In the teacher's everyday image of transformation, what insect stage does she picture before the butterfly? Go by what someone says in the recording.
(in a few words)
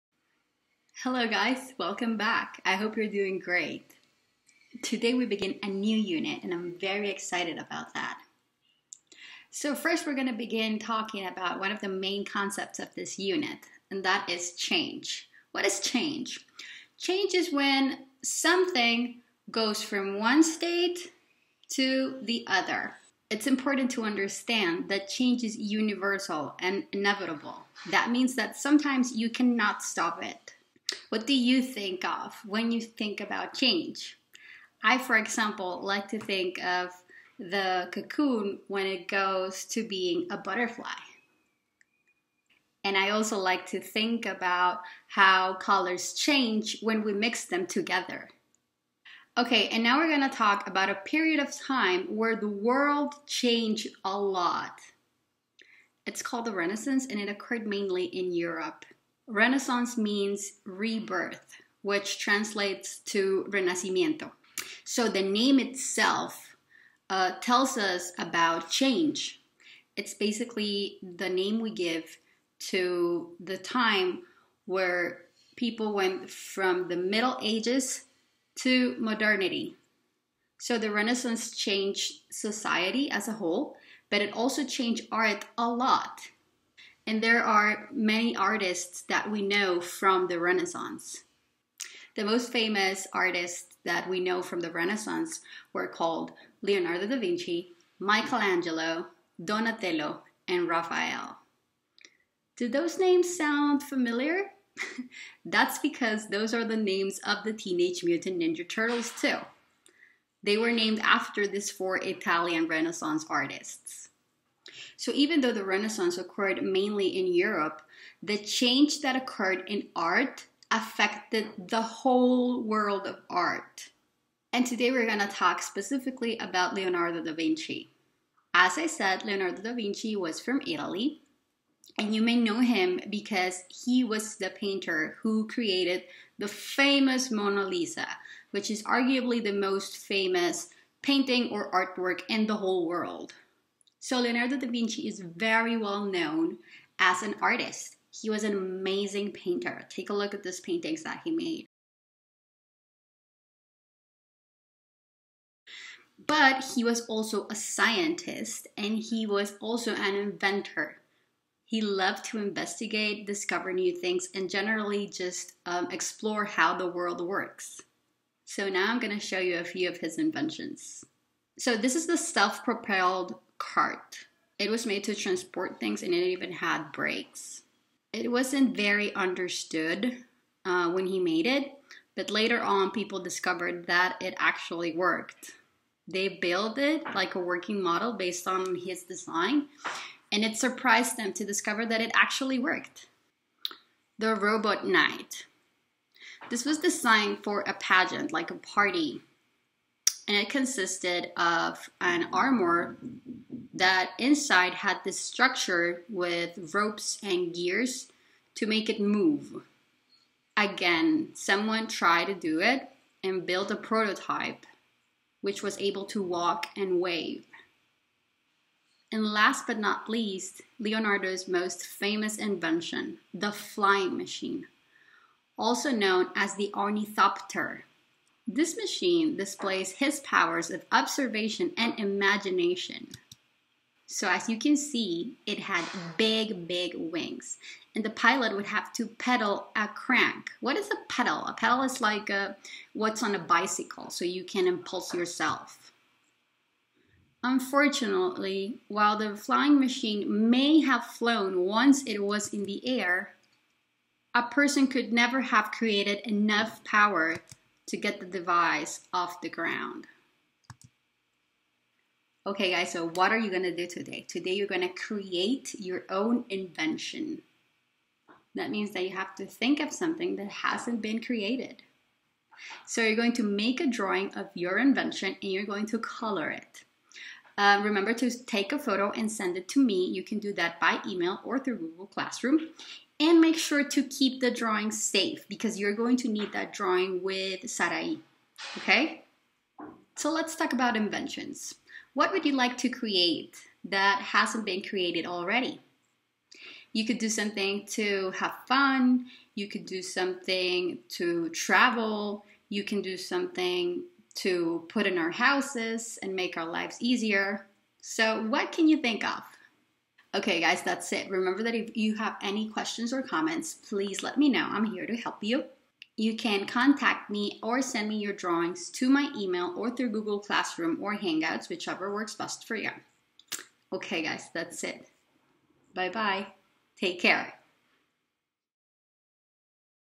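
cocoon.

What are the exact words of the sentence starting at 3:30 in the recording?
Again, someone tried to do it and built a prototype which was able to walk and wave.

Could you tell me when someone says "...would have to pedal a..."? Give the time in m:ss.
3:58.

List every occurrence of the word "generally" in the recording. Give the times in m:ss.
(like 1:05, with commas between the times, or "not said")
2:44.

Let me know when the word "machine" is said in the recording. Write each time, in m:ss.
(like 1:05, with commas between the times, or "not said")
3:44, 3:48, 4:09.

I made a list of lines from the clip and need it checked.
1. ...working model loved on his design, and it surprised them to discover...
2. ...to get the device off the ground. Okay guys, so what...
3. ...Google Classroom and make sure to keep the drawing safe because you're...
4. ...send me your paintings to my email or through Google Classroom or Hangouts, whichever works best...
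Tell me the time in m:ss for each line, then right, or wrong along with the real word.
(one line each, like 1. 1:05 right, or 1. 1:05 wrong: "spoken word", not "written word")
1. 3:07 wrong: "based", not "loved"
2. 4:17 right
3. 4:41 right
4. 5:17 wrong: "drawings", not "paintings".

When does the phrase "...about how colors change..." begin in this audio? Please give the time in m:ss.
0:44.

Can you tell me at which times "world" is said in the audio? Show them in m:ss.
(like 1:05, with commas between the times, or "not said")
0:52, 2:02, 2:22, 2:46.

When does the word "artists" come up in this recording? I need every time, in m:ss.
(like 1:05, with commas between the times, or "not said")
1:28, 1:33, 1:53, 2:27.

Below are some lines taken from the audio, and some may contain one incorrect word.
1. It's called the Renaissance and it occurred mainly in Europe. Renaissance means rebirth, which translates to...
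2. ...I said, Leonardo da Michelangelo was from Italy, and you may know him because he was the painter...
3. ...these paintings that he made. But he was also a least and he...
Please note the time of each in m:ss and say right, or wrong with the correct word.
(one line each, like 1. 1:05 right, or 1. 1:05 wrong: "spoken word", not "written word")
1. 0:56 right
2. 2:08 wrong: "Vinci", not "Michelangelo"
3. 2:30 wrong: "scientist", not "least".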